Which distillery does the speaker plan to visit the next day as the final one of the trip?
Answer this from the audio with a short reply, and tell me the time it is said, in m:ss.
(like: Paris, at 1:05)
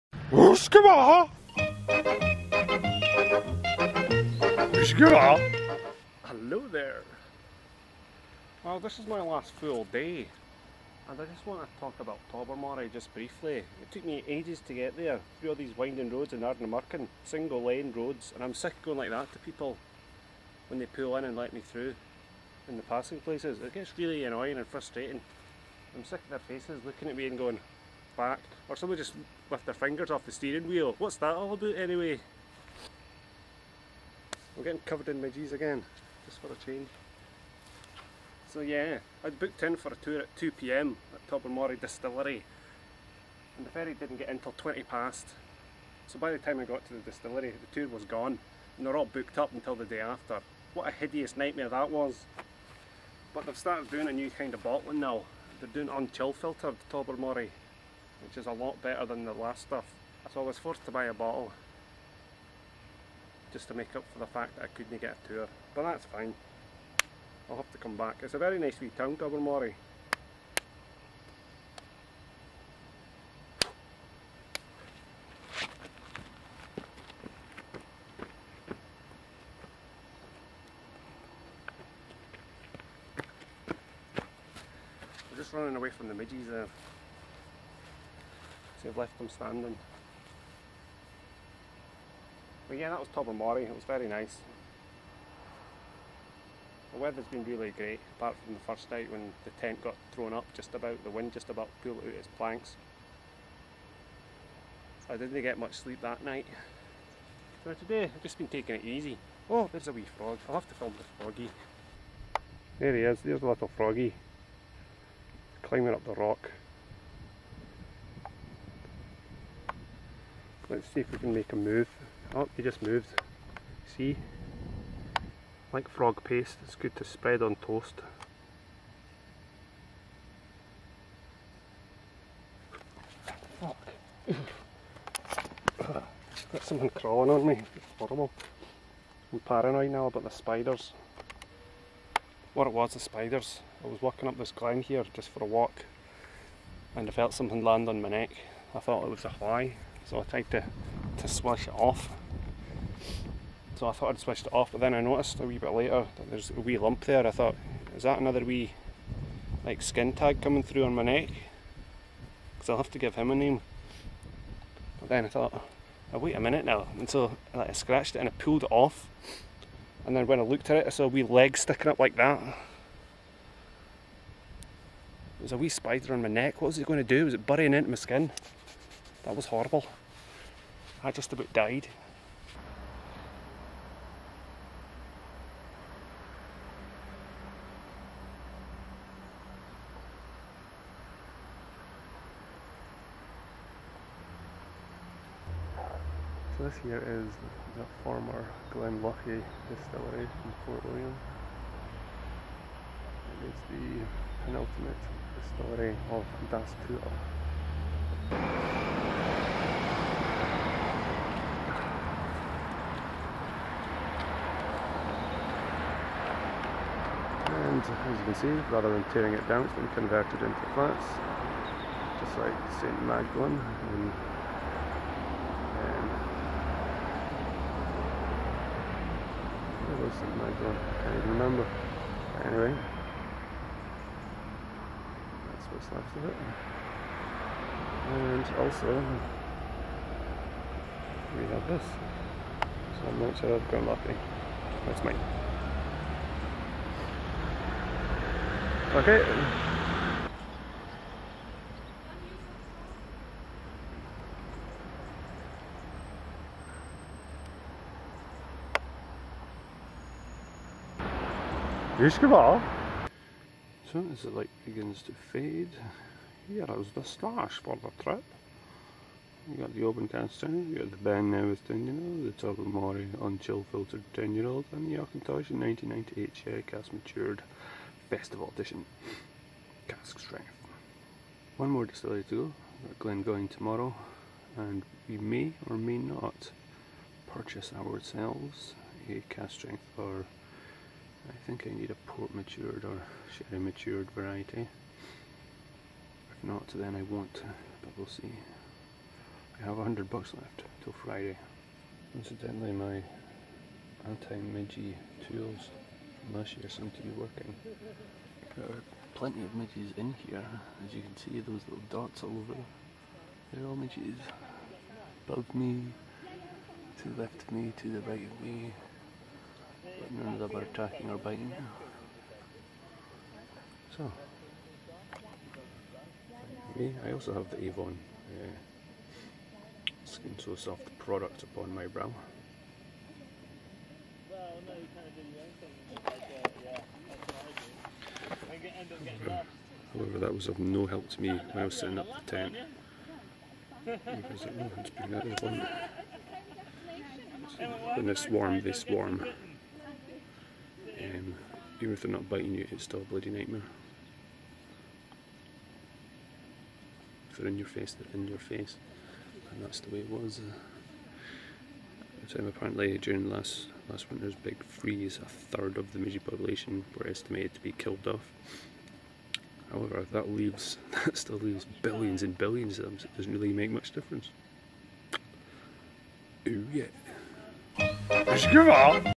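Glengoyne, at 4:43.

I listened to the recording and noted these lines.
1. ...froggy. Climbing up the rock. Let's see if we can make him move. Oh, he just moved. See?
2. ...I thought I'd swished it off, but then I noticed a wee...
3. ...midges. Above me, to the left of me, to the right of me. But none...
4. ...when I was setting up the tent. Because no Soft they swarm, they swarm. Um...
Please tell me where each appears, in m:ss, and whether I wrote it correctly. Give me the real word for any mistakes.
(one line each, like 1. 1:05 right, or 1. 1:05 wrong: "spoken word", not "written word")
1. 1:53 right
2. 2:33 right
3. 5:13 right
4. 5:41 wrong: "When", not "Soft".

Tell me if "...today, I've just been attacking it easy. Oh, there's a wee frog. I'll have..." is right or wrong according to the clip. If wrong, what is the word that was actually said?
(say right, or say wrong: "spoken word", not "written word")
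wrong: "taking", not "attacking".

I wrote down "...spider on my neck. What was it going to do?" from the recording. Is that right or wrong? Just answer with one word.
right.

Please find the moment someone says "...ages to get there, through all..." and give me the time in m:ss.
0:14.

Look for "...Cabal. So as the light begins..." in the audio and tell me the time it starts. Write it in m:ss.
4:22.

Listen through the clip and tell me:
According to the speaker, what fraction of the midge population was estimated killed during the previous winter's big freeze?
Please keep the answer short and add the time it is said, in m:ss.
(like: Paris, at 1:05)
a third, at 6:05.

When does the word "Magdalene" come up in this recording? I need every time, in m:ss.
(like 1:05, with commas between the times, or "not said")
3:43, 3:50.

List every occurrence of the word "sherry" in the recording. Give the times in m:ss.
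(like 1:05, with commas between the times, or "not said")
4:36, 4:53.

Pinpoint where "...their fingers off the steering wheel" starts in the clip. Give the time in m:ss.
0:29.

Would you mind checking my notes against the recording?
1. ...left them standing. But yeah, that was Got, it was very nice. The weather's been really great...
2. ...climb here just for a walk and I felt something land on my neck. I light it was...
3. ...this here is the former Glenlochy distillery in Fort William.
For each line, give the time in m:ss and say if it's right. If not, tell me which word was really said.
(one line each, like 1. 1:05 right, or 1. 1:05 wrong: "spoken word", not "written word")
1. 1:28 wrong: "Tobermory", not "Got"
2. 2:24 wrong: "thought", not "light"
3. 3:16 right.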